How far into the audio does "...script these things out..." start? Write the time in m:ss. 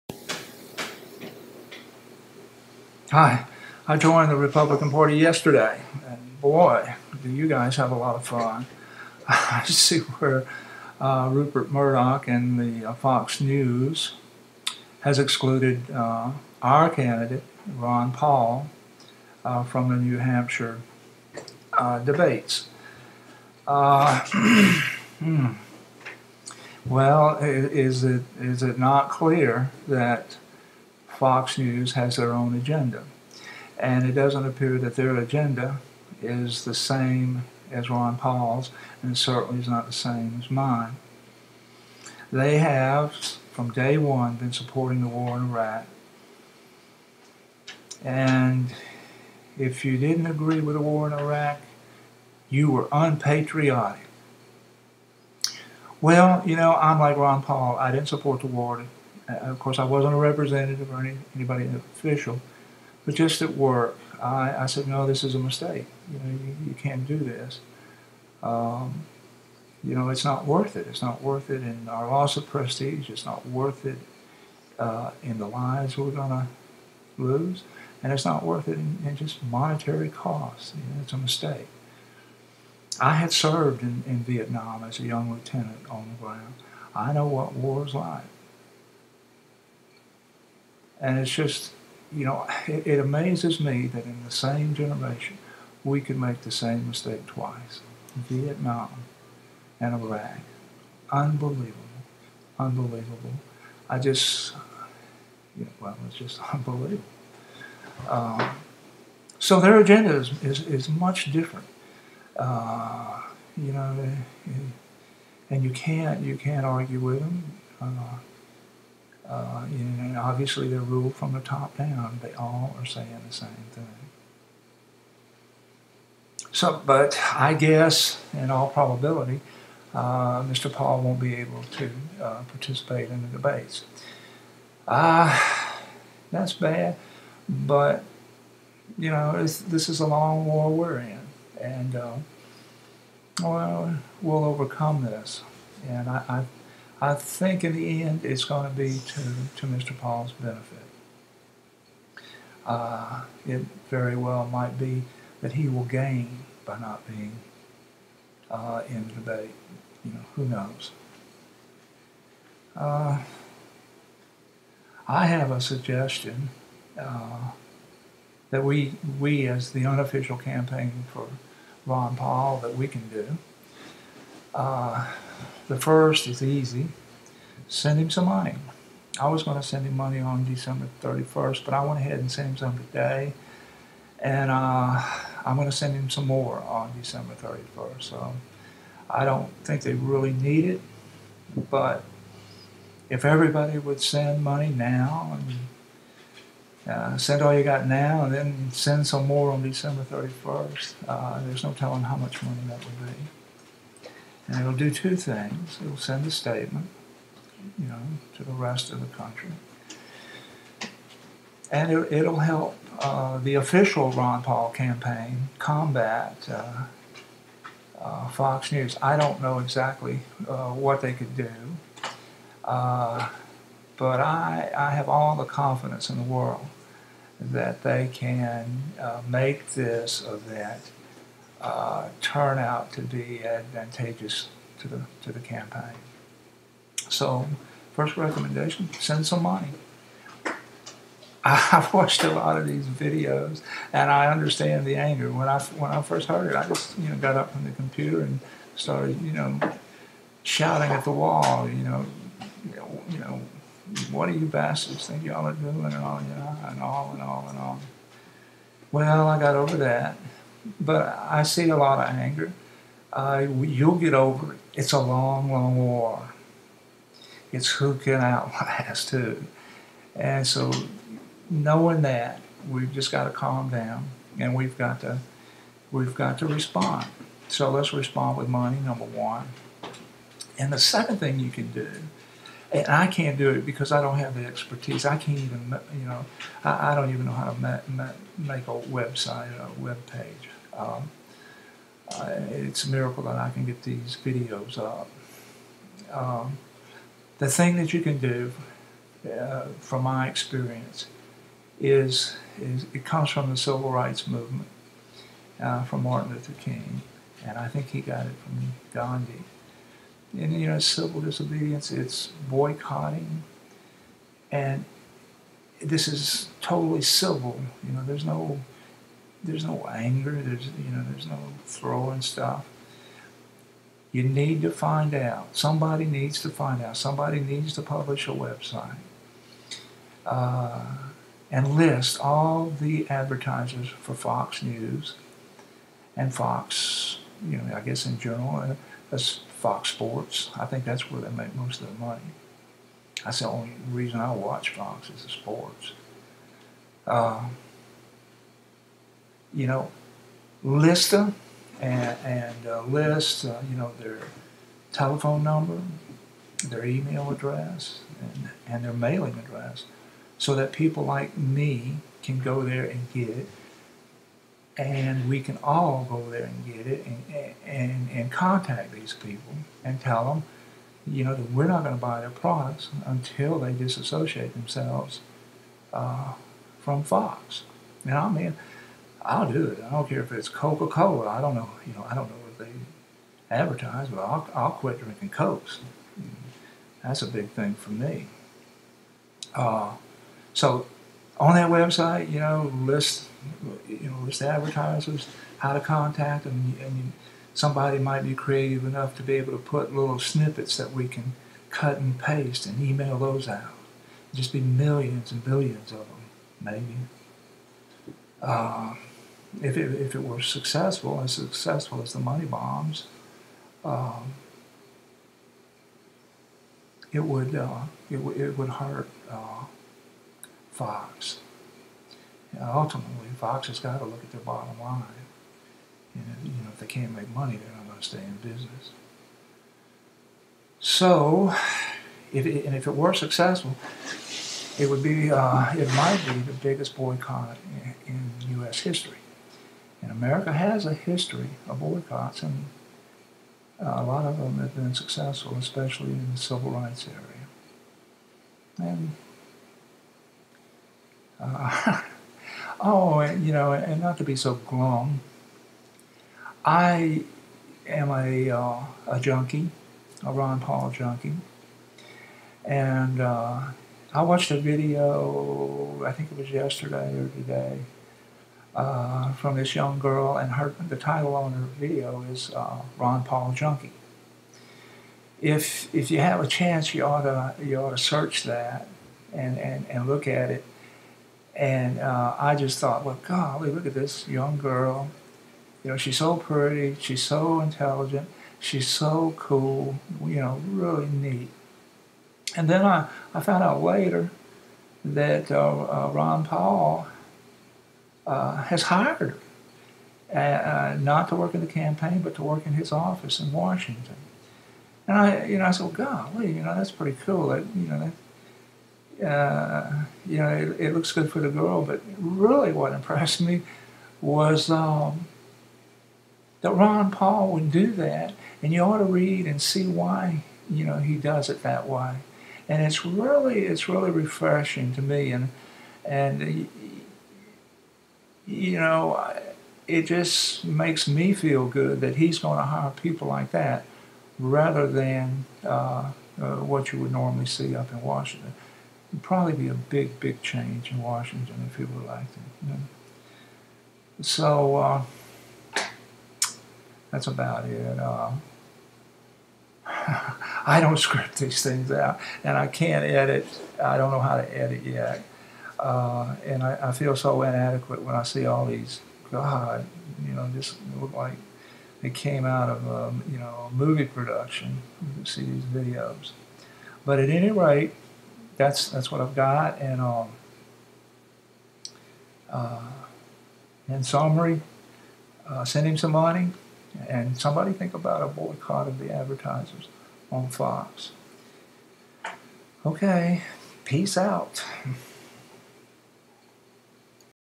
9:10.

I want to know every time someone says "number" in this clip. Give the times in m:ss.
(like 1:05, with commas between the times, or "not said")
4:38, 5:55.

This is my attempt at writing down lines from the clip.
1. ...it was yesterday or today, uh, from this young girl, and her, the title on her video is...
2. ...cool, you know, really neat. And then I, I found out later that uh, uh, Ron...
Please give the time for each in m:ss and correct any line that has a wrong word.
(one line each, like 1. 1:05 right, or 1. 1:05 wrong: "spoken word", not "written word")
1. 7:46 right
2. 8:09 right.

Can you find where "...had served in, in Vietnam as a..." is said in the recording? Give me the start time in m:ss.
1:23.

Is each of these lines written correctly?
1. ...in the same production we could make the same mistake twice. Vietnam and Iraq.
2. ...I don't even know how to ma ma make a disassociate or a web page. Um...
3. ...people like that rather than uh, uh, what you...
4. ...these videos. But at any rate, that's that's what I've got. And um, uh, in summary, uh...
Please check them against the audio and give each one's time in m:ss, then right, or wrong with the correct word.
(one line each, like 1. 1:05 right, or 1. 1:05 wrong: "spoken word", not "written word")
1. 1:34 wrong: "generation", not "production"
2. 4:46 wrong: "website", not "disassociate"
3. 8:52 right
4. 9:25 right.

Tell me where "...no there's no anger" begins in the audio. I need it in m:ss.
5:18.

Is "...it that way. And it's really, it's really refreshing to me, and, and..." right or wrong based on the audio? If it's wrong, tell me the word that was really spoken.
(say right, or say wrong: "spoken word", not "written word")
right.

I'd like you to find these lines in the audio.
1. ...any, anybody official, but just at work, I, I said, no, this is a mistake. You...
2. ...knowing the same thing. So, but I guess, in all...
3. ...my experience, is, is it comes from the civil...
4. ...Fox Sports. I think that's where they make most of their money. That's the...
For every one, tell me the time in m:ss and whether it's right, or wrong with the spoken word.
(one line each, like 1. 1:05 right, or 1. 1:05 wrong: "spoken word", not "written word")
1. 1:00 right
2. 2:02 wrong: "saying", not "knowing"
3. 5:00 right
4. 5:39 right.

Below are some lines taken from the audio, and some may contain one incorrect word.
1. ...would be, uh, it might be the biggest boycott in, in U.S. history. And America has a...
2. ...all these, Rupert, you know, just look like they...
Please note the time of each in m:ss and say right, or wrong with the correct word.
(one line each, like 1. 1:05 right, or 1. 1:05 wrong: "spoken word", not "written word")
1. 7:14 right
2. 9:18 wrong: "God", not "Rupert".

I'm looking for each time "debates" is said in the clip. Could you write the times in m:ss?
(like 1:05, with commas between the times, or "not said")
0:21, 2:13, 2:39.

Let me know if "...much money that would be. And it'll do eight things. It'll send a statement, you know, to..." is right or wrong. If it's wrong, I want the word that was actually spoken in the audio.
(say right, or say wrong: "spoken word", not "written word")
wrong: "two", not "eight".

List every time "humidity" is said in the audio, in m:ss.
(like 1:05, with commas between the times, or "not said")
not said.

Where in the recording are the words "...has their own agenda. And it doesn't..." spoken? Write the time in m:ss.
0:31.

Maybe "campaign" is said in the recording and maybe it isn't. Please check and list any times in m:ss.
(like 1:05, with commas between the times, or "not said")
2:50, 3:34, 3:55, 8:21.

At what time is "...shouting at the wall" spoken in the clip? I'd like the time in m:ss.
4:10.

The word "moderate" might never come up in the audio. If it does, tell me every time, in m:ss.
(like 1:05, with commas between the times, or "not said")
not said.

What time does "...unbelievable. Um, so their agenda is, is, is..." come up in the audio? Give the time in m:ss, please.
1:46.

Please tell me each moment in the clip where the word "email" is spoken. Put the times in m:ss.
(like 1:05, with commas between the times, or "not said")
5:56, 6:42.